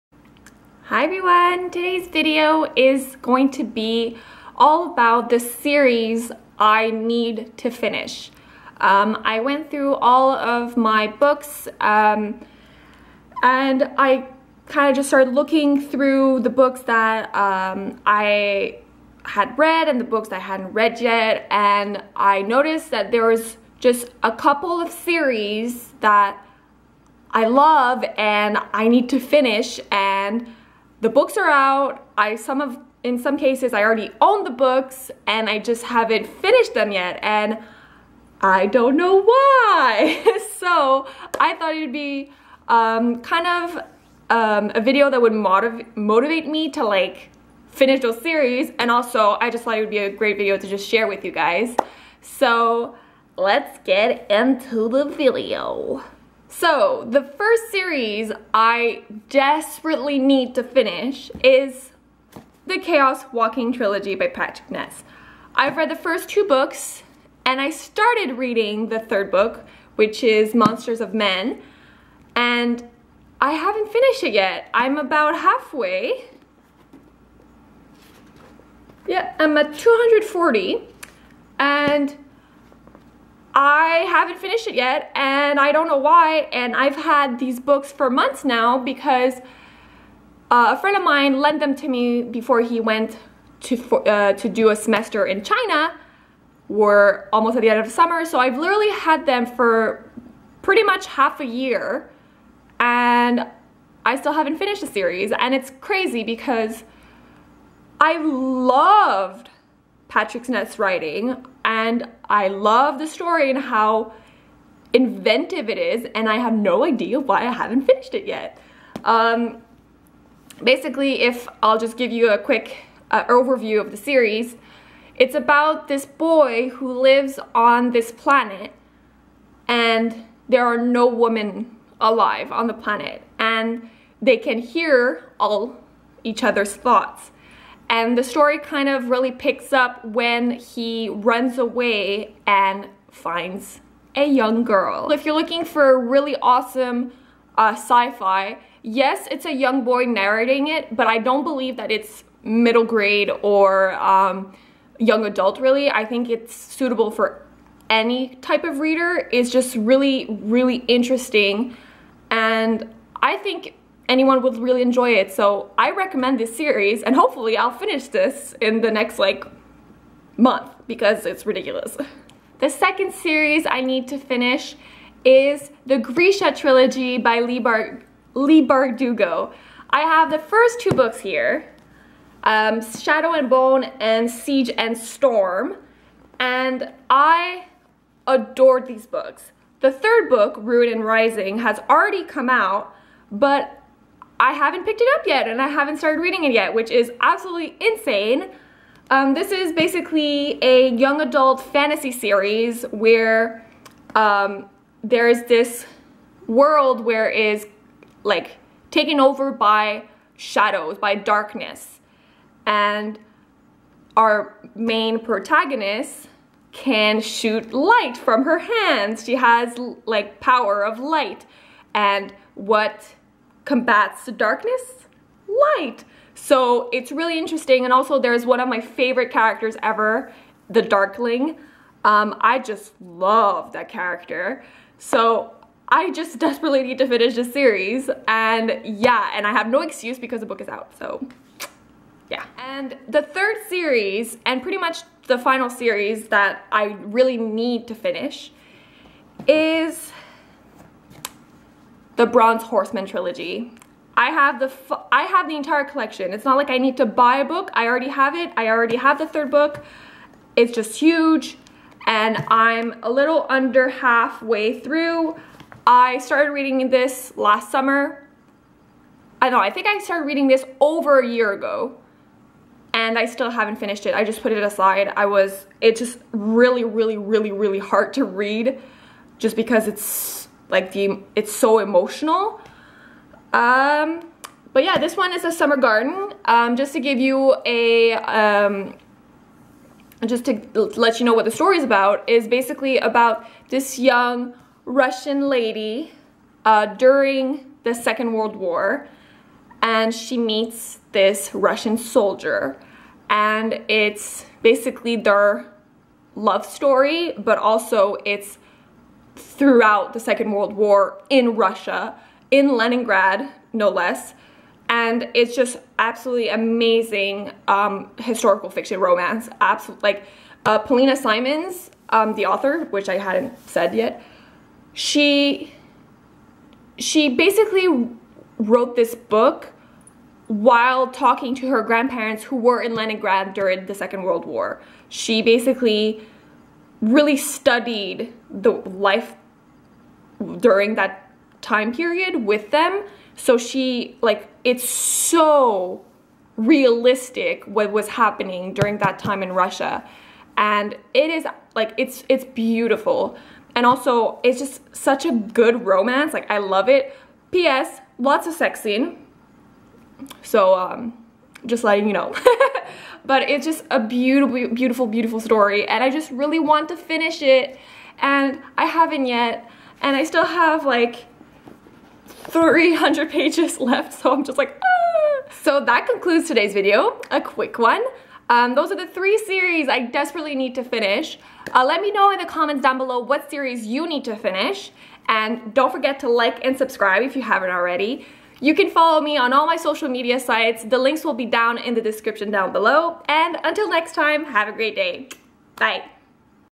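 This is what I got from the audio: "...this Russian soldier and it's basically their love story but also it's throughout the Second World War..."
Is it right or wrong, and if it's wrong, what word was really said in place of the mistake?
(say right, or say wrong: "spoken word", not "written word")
right.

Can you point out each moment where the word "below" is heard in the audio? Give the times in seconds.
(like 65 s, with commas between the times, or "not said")
382 s, 392 s.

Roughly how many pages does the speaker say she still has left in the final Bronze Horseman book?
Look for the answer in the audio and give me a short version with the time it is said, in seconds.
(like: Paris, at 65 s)
300, at 372 s.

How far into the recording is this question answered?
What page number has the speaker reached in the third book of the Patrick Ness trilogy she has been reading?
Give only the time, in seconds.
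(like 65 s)
79 s.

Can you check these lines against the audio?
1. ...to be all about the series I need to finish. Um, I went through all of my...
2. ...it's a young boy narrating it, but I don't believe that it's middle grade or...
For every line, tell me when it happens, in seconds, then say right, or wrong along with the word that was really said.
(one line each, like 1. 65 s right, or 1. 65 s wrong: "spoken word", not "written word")
1. 3 s right
2. 149 s right.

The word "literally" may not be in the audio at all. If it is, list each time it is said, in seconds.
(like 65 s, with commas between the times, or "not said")
98 s.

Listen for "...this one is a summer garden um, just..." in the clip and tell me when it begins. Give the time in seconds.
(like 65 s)
284 s.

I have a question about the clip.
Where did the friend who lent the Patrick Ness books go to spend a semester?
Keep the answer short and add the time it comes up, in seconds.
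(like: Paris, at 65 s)
China, at 95 s.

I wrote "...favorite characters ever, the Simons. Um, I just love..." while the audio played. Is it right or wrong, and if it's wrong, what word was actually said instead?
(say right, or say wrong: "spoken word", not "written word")
wrong: "Darkling", not "Simons".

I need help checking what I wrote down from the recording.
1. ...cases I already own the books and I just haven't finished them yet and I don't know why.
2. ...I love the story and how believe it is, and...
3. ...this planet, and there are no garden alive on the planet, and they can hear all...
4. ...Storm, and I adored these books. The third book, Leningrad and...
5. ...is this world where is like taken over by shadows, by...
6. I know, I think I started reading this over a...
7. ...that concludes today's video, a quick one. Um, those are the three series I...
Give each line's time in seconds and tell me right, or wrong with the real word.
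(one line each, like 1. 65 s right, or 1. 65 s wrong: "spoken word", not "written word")
1. 33 s right
2. 112 s wrong: "inventive", not "believe"
3. 127 s wrong: "women", not "garden"
4. 184 s wrong: "Ruin", not "Leningrad"
5. 205 s right
6. 269 s right
7. 375 s right.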